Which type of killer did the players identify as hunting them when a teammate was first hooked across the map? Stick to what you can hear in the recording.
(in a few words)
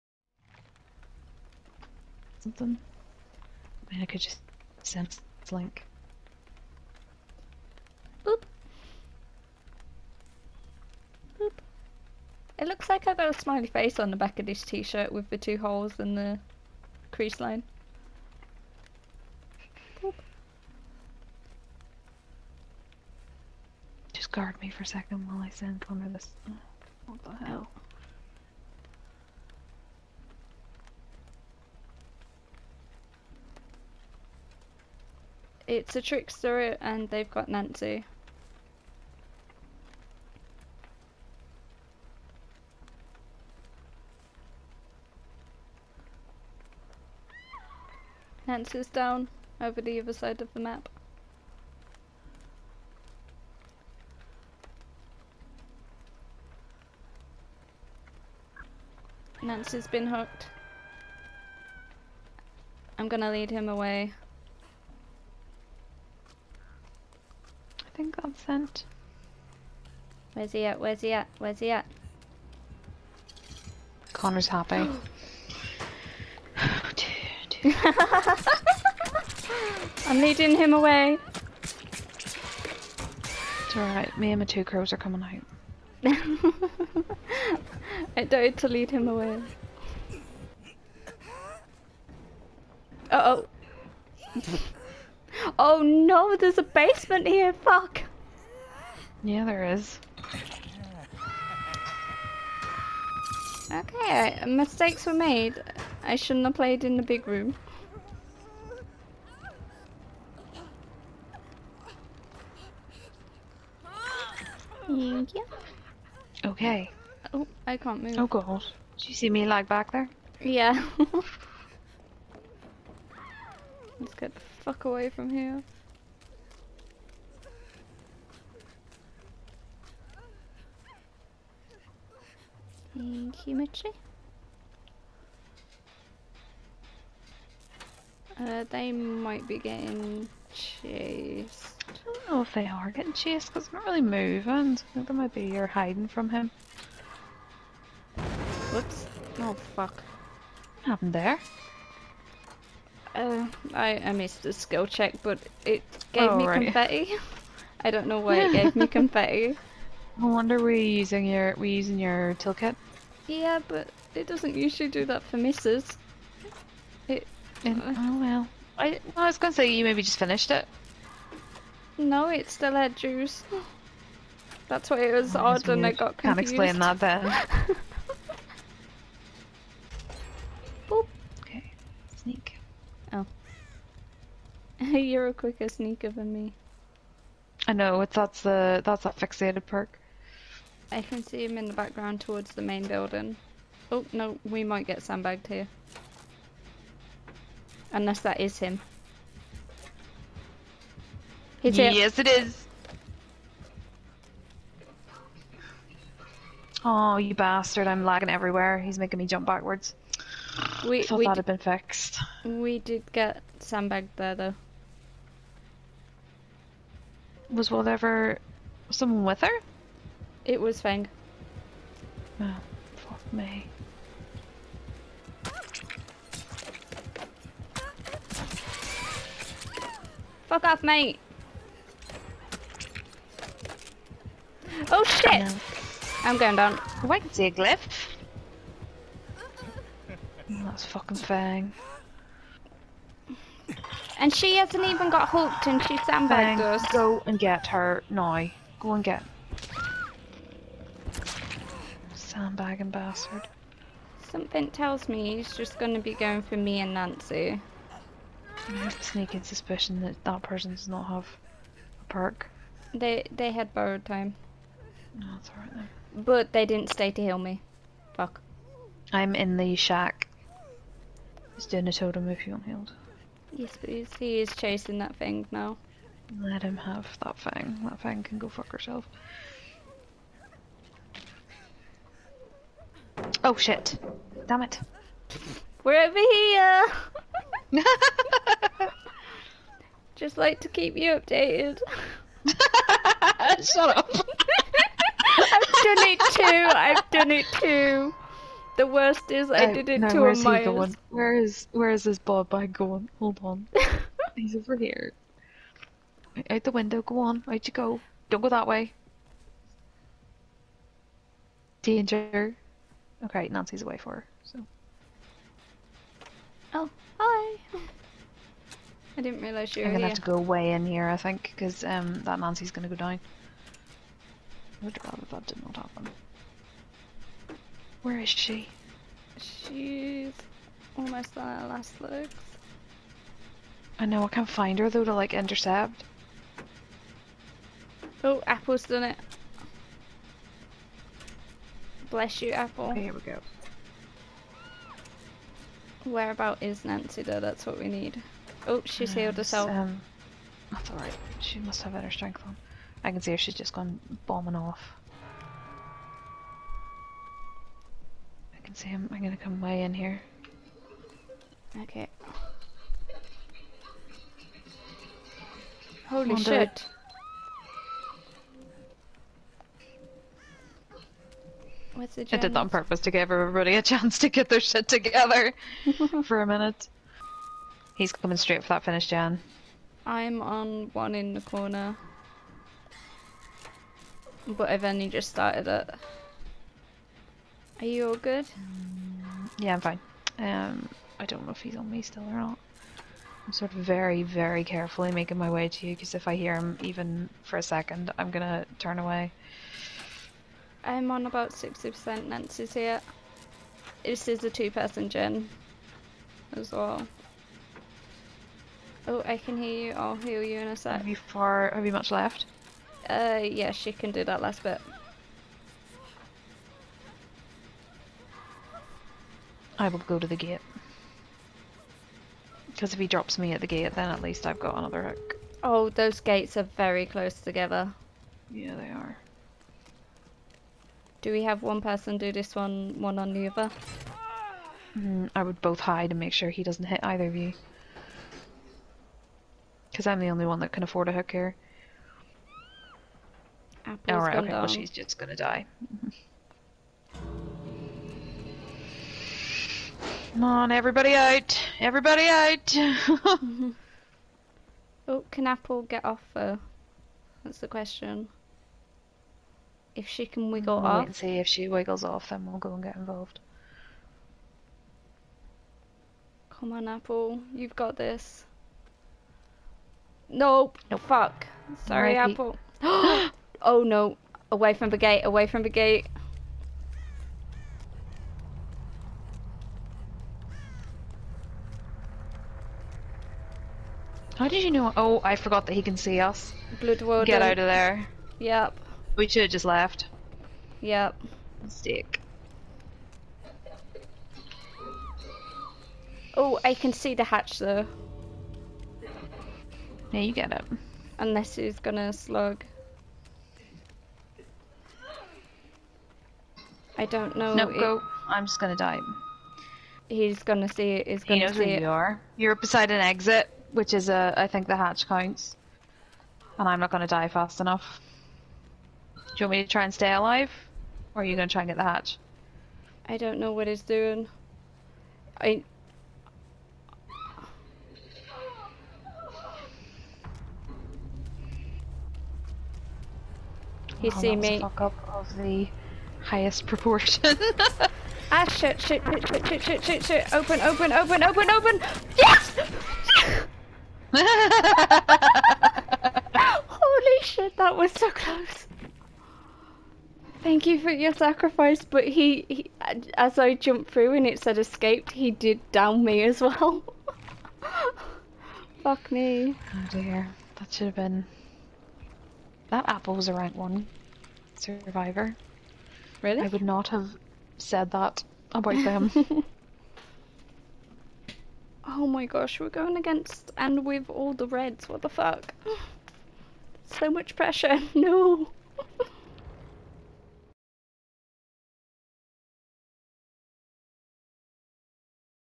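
Trickster.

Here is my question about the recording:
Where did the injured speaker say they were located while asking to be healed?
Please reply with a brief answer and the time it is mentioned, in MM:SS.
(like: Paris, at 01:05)
the shack, at 04:29.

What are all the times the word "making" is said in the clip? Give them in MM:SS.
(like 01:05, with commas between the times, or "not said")
03:28, 06:35.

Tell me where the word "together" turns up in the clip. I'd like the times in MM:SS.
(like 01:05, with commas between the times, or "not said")
06:14, 07:07.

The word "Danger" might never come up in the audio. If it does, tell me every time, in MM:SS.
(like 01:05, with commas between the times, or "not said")
05:11.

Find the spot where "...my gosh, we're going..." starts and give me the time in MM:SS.
09:32.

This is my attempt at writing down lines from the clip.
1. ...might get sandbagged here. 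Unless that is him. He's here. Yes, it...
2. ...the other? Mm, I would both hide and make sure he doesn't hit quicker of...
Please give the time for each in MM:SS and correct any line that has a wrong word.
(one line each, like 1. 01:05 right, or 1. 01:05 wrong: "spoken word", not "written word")
1. 03:14 right
2. 07:13 wrong: "either", not "quicker".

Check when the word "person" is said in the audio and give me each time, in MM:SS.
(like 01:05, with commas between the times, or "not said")
04:20, 06:44, 07:11.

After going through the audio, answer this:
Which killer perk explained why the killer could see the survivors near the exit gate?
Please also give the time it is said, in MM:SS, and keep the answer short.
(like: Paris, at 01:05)
Blood Warden, at 08:06.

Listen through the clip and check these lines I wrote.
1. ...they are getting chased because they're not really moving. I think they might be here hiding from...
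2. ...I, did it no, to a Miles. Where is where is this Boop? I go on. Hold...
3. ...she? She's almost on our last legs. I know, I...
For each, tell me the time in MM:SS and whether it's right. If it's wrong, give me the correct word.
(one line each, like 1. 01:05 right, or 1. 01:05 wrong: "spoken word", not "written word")
1. 02:22 right
2. 04:59 wrong: "Bob", not "Boop"
3. 05:28 right.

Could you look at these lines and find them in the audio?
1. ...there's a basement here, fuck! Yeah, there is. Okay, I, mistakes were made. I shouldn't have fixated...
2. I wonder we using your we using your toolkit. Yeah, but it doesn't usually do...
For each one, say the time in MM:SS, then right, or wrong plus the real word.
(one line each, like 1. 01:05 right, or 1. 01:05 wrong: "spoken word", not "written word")
1. 01:36 wrong: "played", not "fixated"
2. 02:40 right.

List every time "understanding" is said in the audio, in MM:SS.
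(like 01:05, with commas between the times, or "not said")
not said.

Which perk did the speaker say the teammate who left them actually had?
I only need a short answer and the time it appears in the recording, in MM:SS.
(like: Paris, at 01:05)
Borrowed Time, at 04:23.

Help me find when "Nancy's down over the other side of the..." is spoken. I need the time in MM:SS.
00:48.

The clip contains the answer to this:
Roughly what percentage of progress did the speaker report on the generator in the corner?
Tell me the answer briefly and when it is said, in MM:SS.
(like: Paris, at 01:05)
60%, at 06:41.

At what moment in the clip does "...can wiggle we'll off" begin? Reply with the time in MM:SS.
07:40.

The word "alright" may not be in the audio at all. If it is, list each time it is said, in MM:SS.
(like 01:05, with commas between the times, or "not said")
01:23, 04:25, 05:50, 07:24.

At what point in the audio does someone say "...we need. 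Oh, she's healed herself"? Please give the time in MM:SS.
05:47.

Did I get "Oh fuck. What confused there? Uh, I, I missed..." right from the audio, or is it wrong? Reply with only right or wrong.
wrong.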